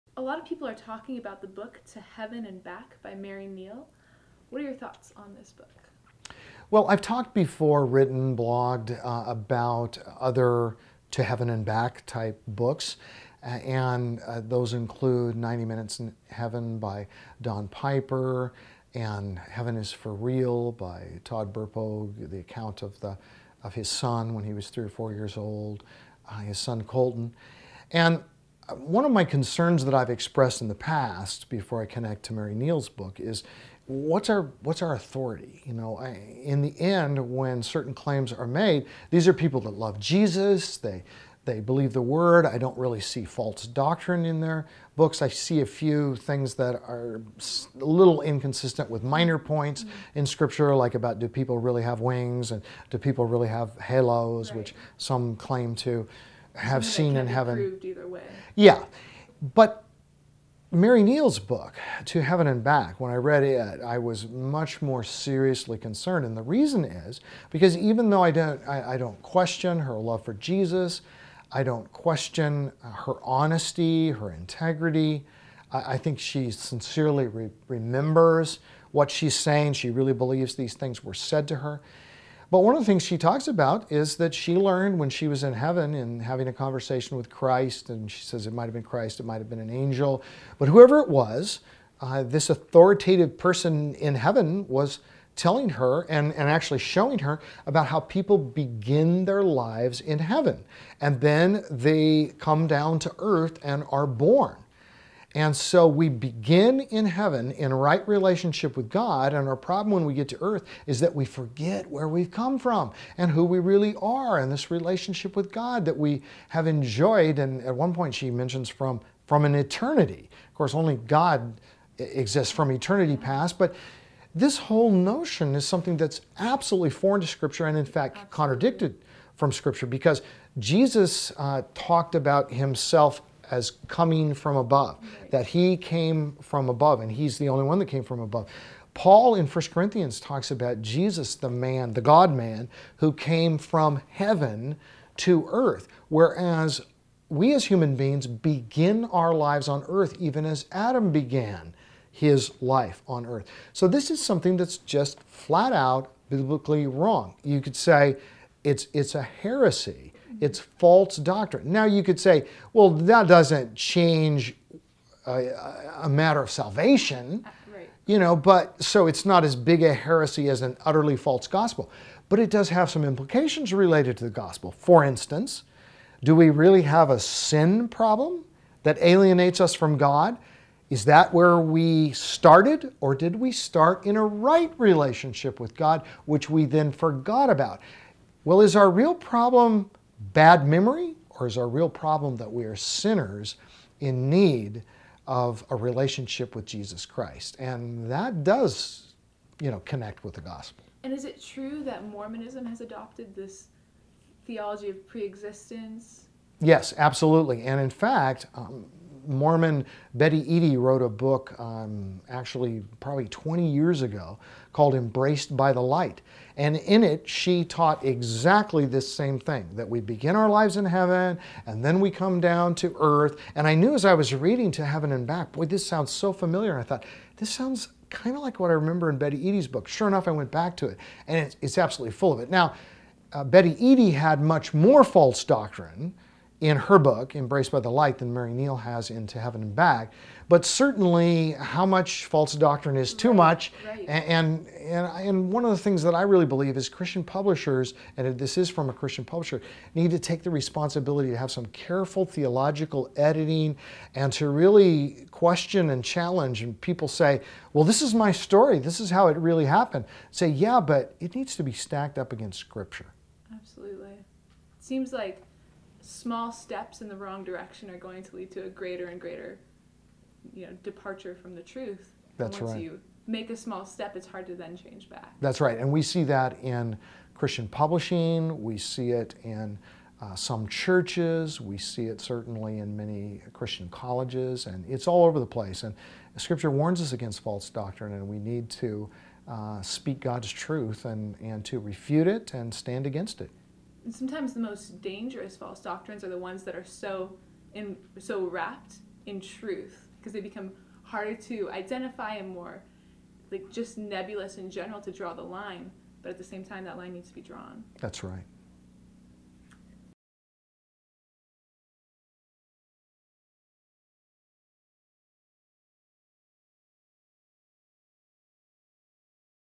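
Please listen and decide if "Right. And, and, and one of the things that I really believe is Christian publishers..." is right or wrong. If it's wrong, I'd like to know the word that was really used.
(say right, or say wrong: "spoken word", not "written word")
right.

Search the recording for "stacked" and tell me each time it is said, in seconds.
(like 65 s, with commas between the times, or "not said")
261 s.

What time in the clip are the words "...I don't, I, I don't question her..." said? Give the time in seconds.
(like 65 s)
68 s.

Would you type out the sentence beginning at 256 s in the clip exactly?
And people say, well, this is my story.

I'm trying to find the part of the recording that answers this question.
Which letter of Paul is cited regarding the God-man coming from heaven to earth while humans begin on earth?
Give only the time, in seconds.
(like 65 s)
139 s.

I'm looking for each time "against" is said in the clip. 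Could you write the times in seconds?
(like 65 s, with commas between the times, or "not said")
262 s, 287 s, 293 s.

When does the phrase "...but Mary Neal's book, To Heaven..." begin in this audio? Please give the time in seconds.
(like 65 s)
59 s.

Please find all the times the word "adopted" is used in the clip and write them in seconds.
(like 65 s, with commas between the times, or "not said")
202 s.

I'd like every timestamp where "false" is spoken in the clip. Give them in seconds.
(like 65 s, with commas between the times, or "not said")
43 s, 160 s, 171 s, 235 s, 242 s, 287 s, 295 s.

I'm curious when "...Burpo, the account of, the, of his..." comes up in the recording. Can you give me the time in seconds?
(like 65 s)
21 s.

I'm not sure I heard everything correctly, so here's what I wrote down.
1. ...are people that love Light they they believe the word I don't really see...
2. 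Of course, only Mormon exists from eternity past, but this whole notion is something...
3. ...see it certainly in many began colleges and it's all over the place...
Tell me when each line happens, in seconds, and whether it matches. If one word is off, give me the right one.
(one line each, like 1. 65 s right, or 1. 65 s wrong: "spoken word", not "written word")
1. 39 s wrong: "Jesus", not "Light"
2. 120 s wrong: "God", not "Mormon"
3. 281 s wrong: "christian", not "began".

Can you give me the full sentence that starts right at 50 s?
in scripture like about do people really have wings and do people really have halos right.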